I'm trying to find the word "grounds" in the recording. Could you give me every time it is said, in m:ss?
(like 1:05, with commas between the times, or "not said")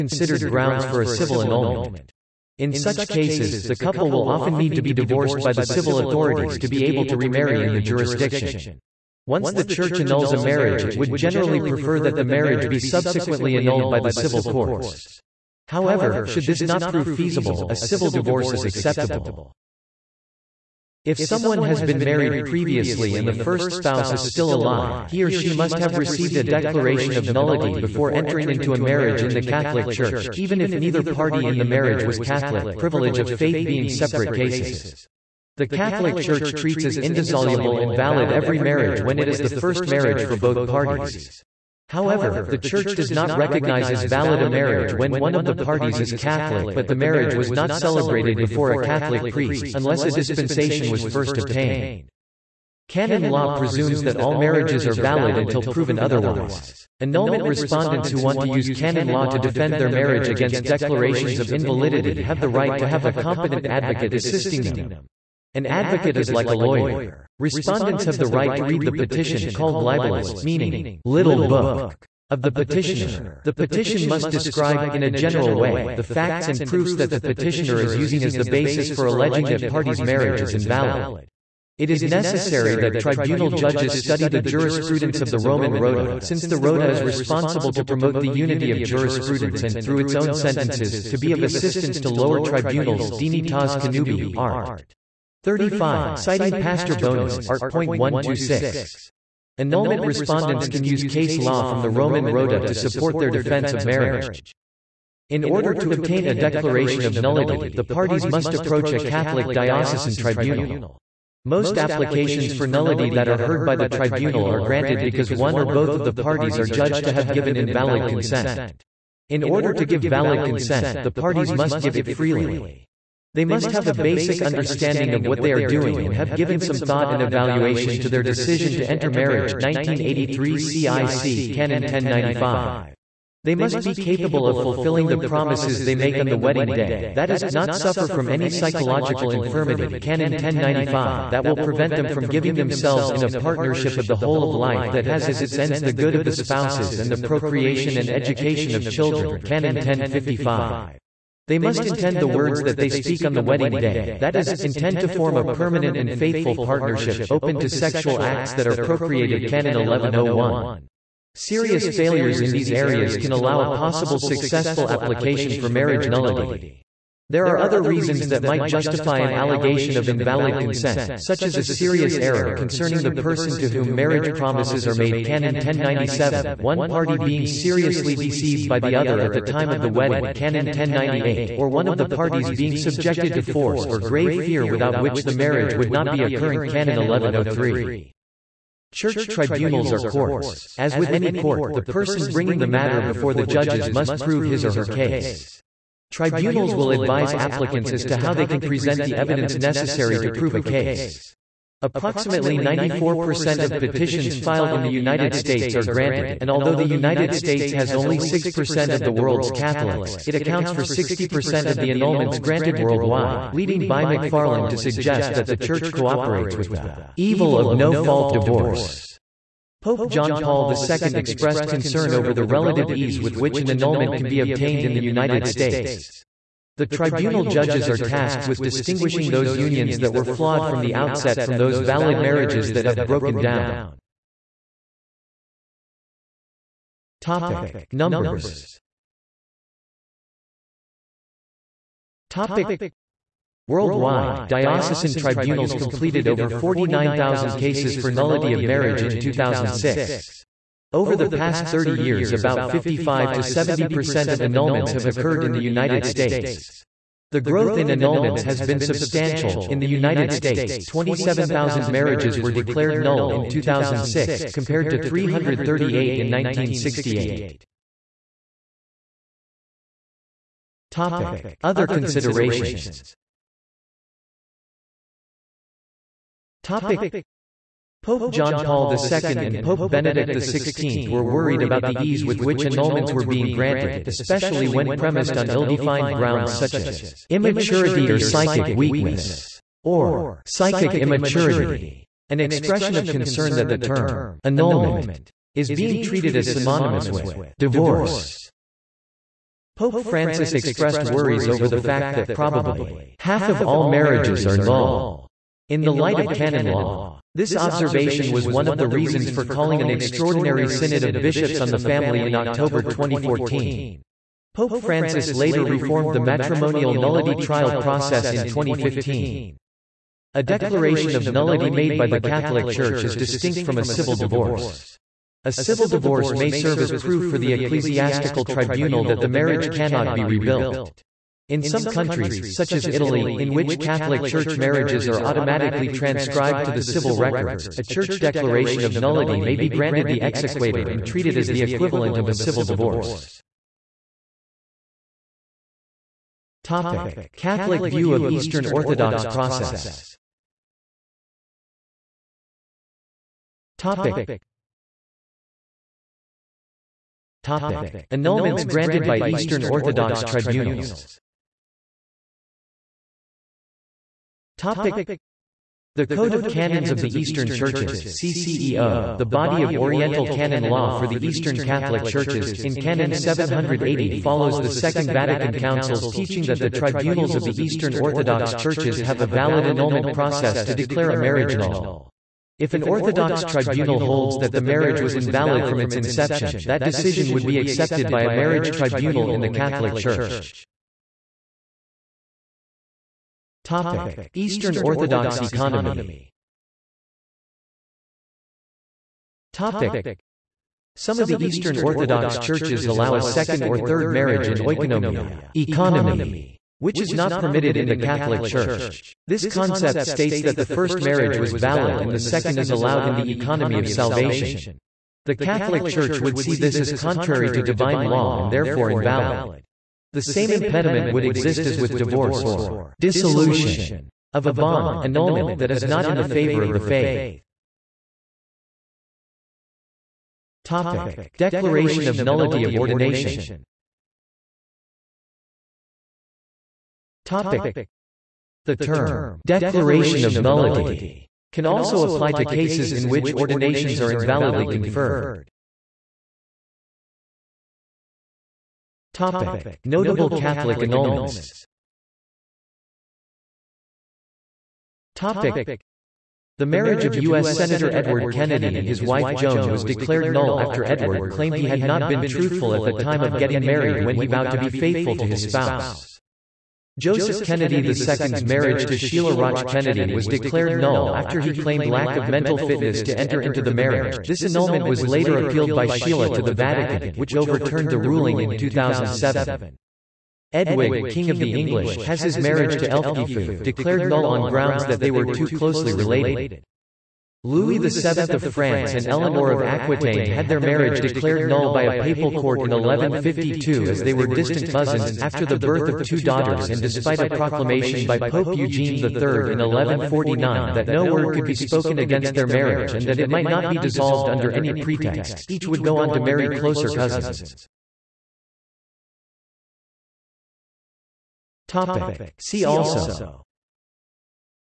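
0:00, 4:46, 8:04.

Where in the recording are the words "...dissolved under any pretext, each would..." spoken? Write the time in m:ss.
8:23.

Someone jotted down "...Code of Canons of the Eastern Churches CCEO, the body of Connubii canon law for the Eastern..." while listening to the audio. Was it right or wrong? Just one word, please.
wrong.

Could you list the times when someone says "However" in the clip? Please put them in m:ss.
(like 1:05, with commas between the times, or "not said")
0:15, 0:41.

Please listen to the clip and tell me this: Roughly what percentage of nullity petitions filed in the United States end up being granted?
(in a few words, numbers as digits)
94%.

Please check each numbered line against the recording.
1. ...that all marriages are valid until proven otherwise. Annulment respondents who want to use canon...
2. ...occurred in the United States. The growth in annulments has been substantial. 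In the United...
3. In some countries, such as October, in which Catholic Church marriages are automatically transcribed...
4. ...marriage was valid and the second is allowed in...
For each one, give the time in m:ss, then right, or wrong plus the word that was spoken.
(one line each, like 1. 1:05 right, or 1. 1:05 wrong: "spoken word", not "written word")
1. 0:54 right
2. 4:15 right
3. 5:31 wrong: "Italy", not "October"
4. 6:50 right.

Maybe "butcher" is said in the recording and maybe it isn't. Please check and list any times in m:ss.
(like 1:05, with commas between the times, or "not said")
not said.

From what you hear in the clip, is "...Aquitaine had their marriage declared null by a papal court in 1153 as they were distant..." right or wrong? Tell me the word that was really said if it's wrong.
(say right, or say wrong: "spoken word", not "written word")
wrong: "1152", not "1153".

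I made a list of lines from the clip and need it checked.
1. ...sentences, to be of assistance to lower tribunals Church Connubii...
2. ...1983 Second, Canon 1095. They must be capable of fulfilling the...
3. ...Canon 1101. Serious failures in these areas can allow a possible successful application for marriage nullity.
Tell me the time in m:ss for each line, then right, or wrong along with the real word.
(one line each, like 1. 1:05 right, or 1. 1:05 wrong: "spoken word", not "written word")
1. 1:30 wrong: "Taz", not "Church"
2. 2:09 wrong: "CIC", not "Second"
3. 2:39 right.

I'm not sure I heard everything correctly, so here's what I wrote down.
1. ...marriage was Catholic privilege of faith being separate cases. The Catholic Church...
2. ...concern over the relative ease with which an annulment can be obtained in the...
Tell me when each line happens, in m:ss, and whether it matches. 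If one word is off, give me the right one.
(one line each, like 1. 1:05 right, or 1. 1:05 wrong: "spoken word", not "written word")
1. 0:31 right
2. 3:41 right.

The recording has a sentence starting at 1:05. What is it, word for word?
An advocate is like a lawyer.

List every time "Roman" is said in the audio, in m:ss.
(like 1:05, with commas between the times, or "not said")
1:25, 1:41.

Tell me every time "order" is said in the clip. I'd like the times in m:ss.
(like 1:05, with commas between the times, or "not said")
1:45, 1:59.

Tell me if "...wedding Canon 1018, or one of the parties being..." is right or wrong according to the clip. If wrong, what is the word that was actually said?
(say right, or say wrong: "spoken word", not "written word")
wrong: "1098", not "1018".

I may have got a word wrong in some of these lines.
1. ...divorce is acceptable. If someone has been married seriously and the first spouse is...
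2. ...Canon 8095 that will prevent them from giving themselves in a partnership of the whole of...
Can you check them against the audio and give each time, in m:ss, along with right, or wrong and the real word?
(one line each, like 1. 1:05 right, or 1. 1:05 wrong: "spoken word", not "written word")
1. 0:18 wrong: "previously", not "seriously"
2. 2:19 wrong: "1095", not "8095".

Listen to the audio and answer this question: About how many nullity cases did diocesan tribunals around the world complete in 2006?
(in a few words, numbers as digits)
over 49,000.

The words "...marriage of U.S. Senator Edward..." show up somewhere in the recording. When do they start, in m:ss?
7:36.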